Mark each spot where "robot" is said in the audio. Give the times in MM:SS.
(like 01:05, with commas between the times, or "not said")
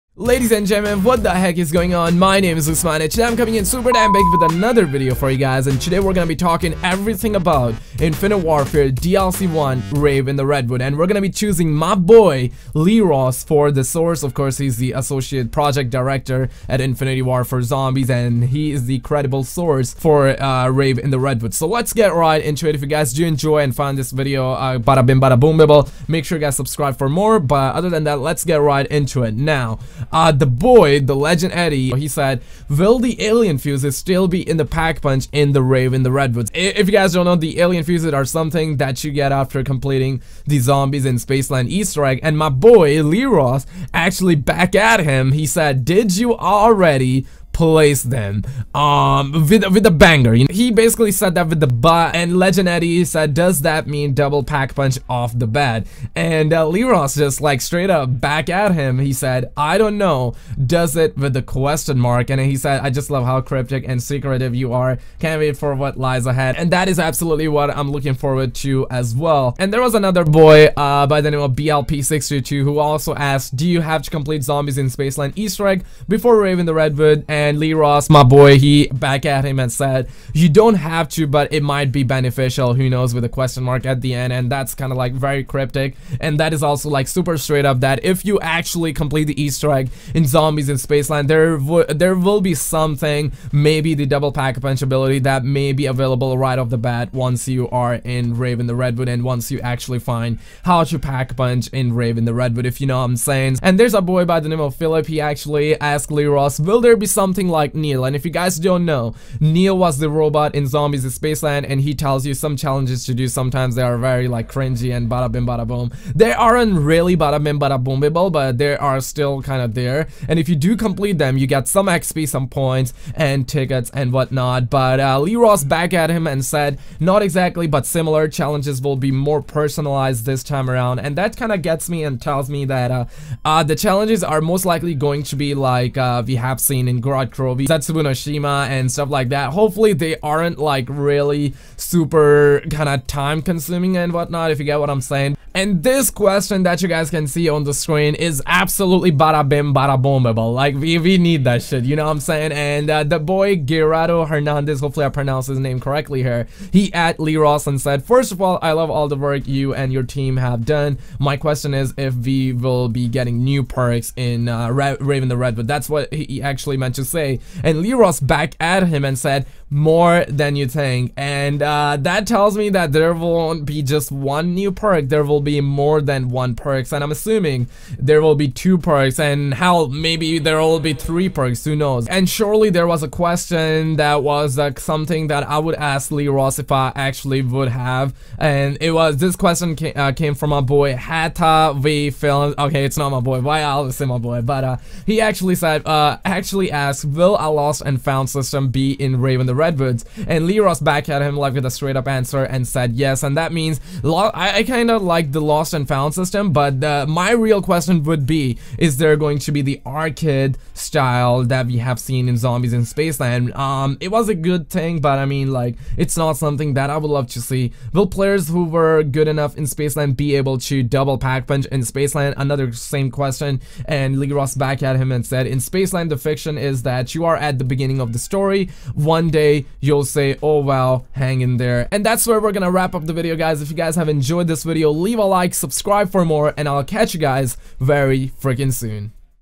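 01:50.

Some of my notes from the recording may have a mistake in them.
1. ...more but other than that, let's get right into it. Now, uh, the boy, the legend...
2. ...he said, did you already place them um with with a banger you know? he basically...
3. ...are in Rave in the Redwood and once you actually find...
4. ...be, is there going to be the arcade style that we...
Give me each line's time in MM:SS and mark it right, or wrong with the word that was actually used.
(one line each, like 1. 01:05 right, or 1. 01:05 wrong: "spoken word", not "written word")
1. 00:27 right
2. 00:45 right
3. 01:37 right
4. 03:28 right.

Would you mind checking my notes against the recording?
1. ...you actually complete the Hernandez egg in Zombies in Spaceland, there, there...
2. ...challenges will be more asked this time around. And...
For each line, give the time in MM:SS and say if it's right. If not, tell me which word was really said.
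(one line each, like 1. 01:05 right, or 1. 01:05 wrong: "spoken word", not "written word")
1. 01:28 wrong: "Easter", not "Hernandez"
2. 02:08 wrong: "personalized", not "asked".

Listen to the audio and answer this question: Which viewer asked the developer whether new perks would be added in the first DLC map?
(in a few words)
Gerardo Hernandez.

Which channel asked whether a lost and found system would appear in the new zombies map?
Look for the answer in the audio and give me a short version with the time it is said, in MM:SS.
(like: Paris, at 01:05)
Hata V Films, at 03:10.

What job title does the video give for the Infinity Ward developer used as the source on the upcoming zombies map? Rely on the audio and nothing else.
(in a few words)
associate project director.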